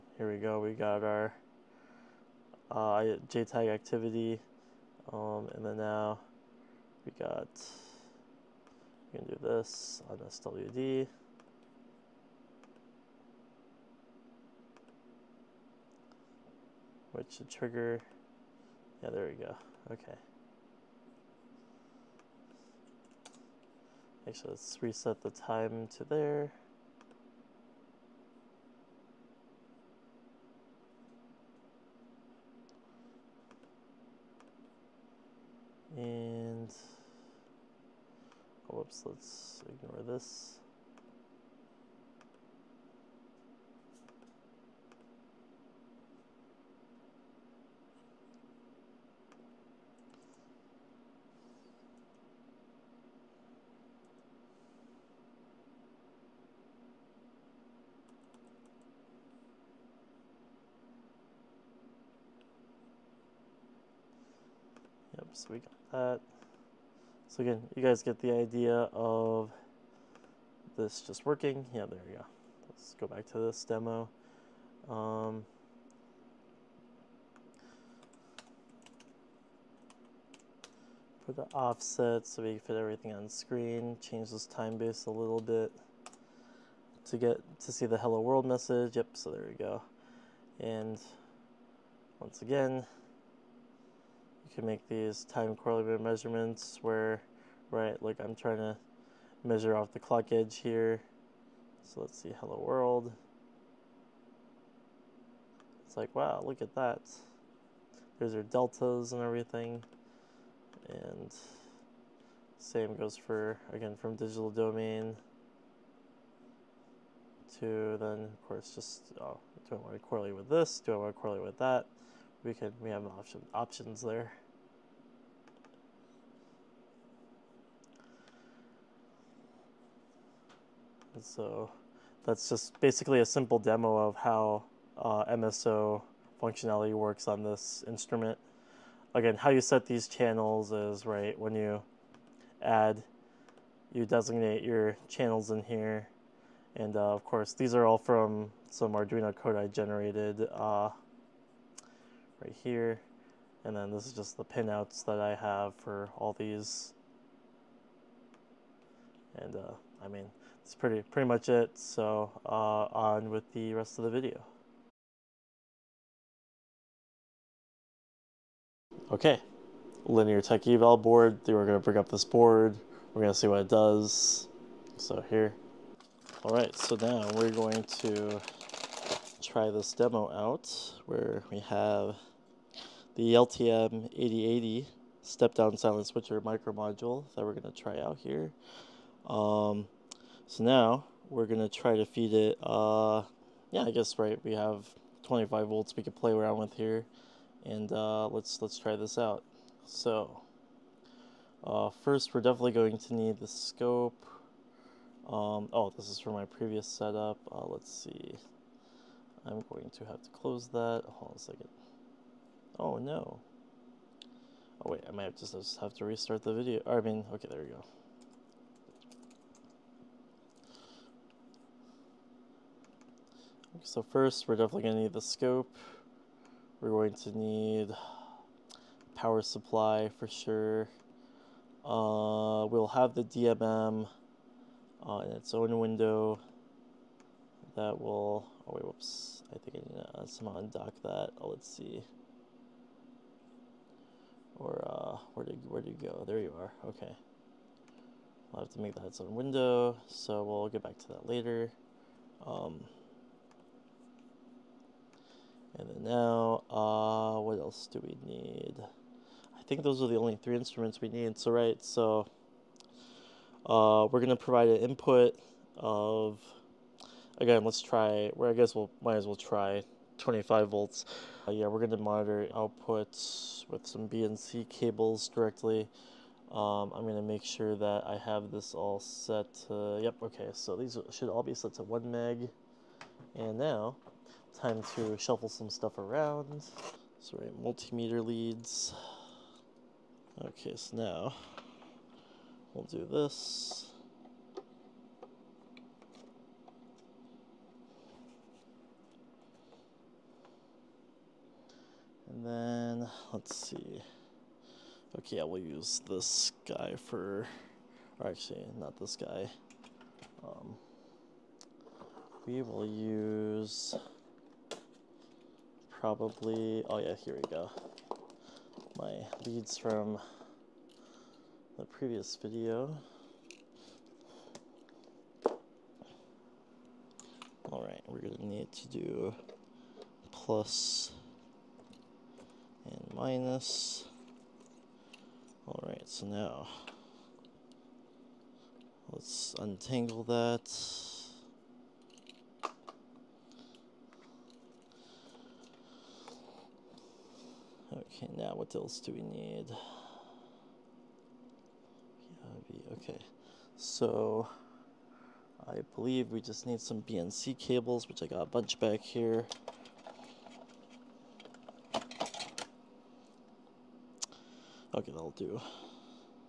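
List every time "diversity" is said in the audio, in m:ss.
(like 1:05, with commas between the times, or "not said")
not said.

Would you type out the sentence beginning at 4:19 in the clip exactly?
I think those are the only three instruments we need.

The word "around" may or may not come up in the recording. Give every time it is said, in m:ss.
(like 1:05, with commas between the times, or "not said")
3:16, 4:45.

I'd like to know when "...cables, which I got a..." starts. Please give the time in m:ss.
5:57.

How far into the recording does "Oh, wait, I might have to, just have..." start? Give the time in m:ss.
3:34.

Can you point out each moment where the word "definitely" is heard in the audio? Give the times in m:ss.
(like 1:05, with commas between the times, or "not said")
3:22, 3:44.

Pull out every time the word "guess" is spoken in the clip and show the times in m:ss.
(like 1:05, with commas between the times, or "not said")
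3:13, 4:28.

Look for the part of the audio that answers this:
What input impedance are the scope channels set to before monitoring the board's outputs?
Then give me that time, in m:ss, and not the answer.
4:41.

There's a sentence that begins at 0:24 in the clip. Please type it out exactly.
Actually, let's reset the time to there.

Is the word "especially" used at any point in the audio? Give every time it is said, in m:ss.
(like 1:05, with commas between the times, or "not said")
not said.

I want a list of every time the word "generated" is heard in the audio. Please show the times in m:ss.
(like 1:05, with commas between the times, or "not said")
2:29.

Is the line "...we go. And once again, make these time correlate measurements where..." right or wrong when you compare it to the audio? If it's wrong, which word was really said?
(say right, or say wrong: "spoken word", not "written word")
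right.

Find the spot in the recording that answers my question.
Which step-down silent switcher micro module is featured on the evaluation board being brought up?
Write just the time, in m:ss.
3:03.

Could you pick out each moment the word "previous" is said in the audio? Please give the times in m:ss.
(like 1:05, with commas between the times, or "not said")
3:26, 5:21.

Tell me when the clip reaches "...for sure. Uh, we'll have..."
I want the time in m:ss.
3:50.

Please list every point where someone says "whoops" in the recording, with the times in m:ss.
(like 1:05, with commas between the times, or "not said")
0:38, 3:58.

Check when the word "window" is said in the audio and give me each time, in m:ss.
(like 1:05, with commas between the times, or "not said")
3:55, 4:09.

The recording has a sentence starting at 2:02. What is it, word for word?
We can, we have option, options there.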